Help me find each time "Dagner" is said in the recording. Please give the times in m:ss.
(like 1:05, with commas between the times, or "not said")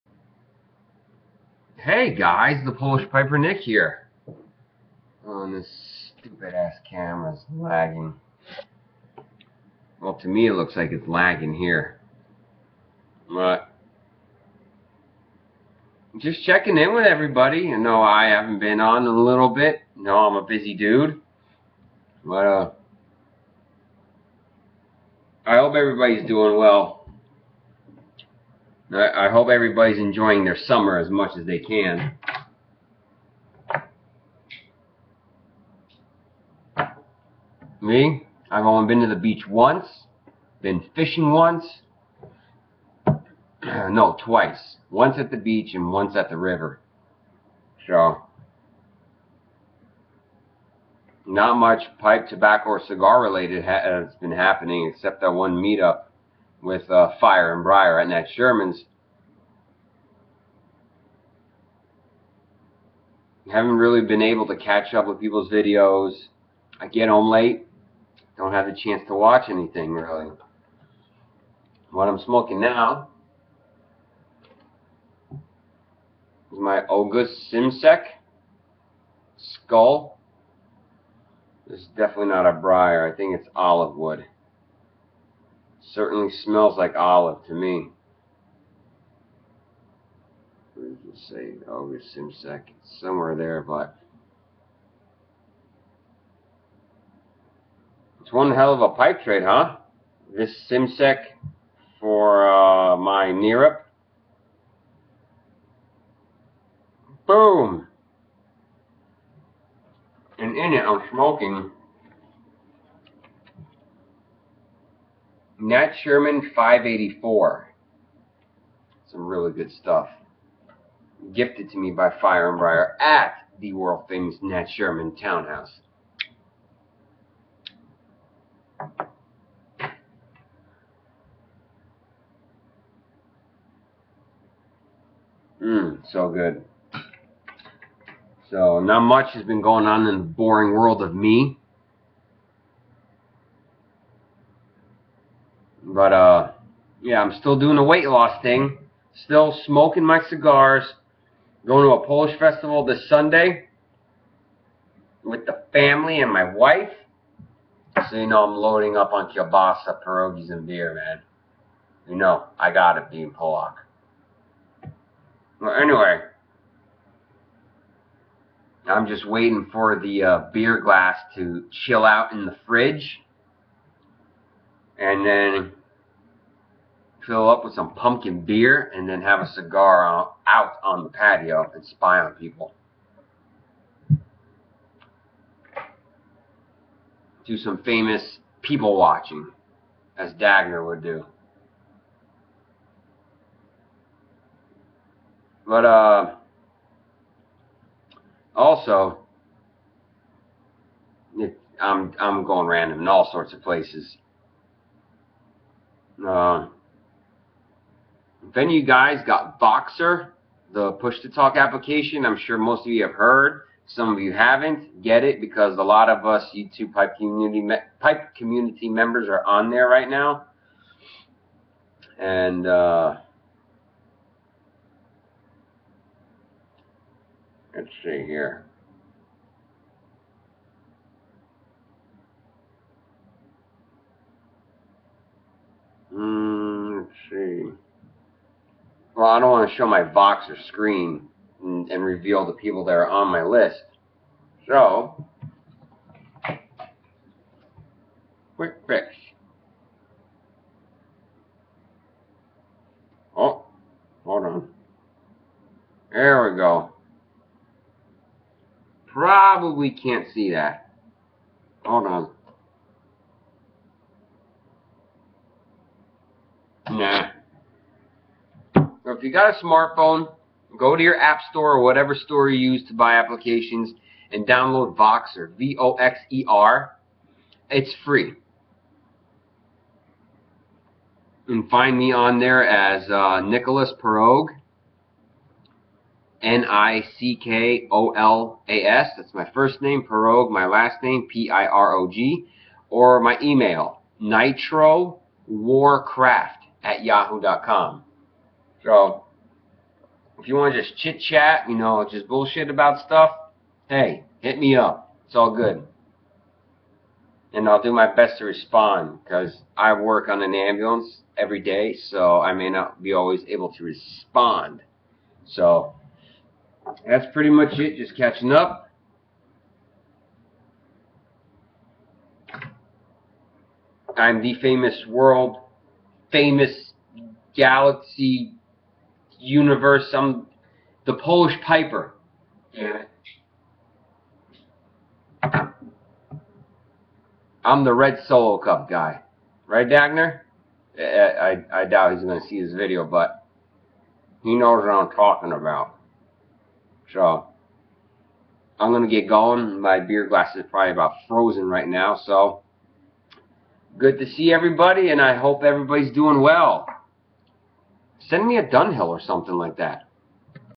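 3:10, 5:39.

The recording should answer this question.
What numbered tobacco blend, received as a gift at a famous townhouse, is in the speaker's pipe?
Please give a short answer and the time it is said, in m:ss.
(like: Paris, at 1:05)
Nat Sherman 584, at 1:55.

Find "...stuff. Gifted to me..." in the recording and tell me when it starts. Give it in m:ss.
1:59.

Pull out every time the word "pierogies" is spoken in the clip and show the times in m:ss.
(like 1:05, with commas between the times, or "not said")
2:40.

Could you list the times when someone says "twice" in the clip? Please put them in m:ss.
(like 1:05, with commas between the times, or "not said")
0:44.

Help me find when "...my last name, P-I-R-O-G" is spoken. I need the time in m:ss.
4:50.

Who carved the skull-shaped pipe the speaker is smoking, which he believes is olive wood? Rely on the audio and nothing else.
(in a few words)
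Oguz Simsek.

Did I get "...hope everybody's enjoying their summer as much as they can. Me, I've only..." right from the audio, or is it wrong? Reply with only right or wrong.
right.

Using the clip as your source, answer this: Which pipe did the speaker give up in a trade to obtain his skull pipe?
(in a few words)
Neerup.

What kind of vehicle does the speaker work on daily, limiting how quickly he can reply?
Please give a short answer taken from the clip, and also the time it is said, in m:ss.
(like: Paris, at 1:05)
Ambulance, at 5:10.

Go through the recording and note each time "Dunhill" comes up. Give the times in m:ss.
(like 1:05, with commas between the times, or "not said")
5:58.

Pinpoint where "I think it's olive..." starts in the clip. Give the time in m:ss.
1:23.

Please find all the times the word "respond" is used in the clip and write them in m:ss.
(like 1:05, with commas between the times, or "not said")
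5:08, 5:13.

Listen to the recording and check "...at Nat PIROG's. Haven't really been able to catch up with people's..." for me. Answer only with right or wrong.
wrong.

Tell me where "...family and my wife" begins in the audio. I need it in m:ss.
2:35.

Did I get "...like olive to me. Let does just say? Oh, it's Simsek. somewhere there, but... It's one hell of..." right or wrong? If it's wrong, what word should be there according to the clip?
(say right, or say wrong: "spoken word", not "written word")
right.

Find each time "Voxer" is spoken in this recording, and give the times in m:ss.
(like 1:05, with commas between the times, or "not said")
3:29, 4:00, 4:34.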